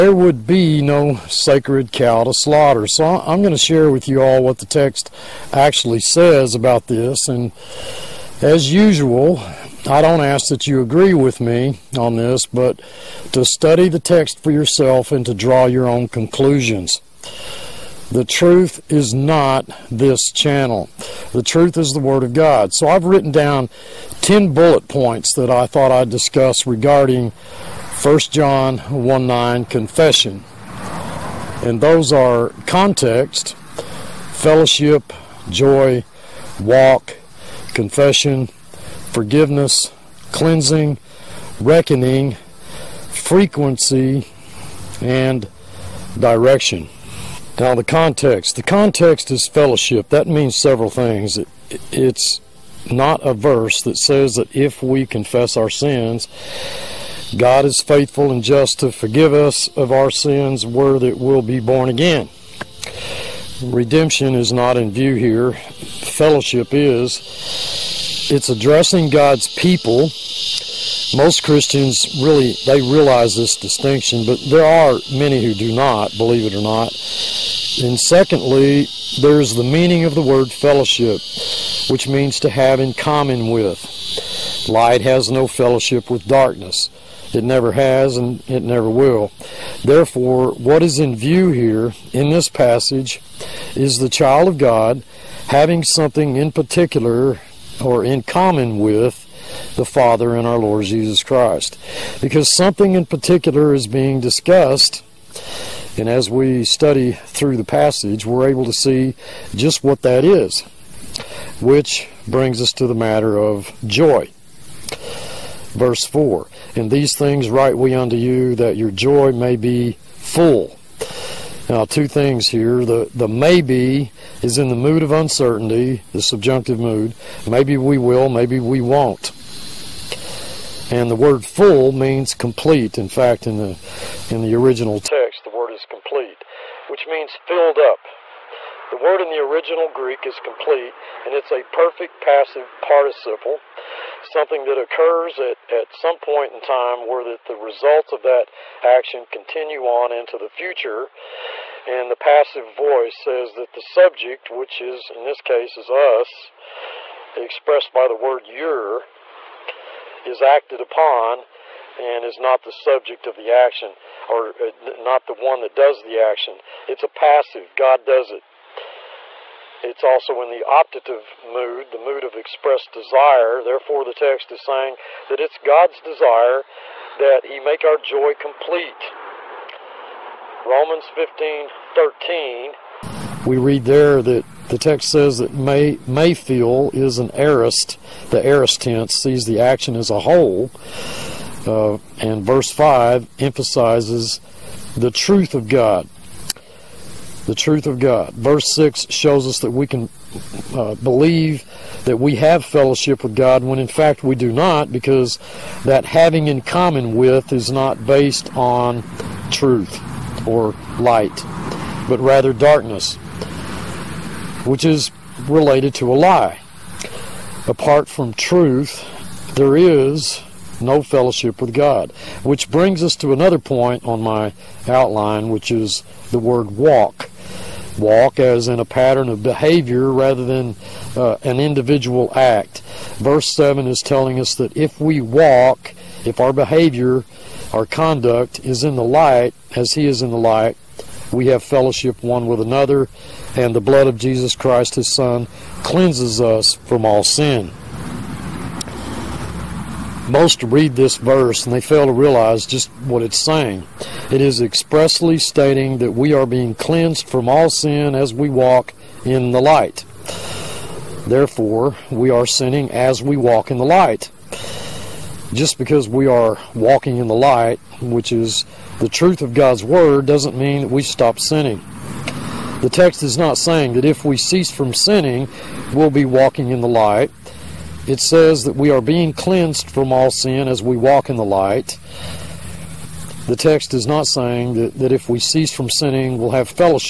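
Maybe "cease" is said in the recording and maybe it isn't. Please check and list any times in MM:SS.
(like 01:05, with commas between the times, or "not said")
04:34, 04:45.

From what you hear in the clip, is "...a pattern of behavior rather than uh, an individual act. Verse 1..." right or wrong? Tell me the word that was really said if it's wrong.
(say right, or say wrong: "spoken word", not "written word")
wrong: "7", not "1".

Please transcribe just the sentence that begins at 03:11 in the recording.
Uh, and verse 5 emphasizes the truth of God the truth of God.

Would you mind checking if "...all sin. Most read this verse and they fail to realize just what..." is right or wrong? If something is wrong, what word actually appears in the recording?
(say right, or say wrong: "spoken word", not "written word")
right.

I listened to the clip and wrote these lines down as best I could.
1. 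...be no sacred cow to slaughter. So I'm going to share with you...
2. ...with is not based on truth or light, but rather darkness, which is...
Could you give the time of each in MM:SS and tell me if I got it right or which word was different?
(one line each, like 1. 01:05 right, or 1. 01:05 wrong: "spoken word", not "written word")
1. 00:00 right
2. 03:27 right.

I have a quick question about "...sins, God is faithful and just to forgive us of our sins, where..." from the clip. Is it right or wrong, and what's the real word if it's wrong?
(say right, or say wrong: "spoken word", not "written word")
right.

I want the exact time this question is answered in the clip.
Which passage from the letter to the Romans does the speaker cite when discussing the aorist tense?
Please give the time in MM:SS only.
03:00.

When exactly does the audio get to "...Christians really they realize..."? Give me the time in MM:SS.
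01:11.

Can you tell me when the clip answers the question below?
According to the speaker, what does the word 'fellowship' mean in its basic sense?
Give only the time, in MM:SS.
01:22.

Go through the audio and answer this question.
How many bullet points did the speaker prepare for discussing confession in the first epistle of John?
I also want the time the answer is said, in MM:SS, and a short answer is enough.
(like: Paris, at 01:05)
10, at 00:24.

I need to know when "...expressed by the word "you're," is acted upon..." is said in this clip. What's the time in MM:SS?
02:37.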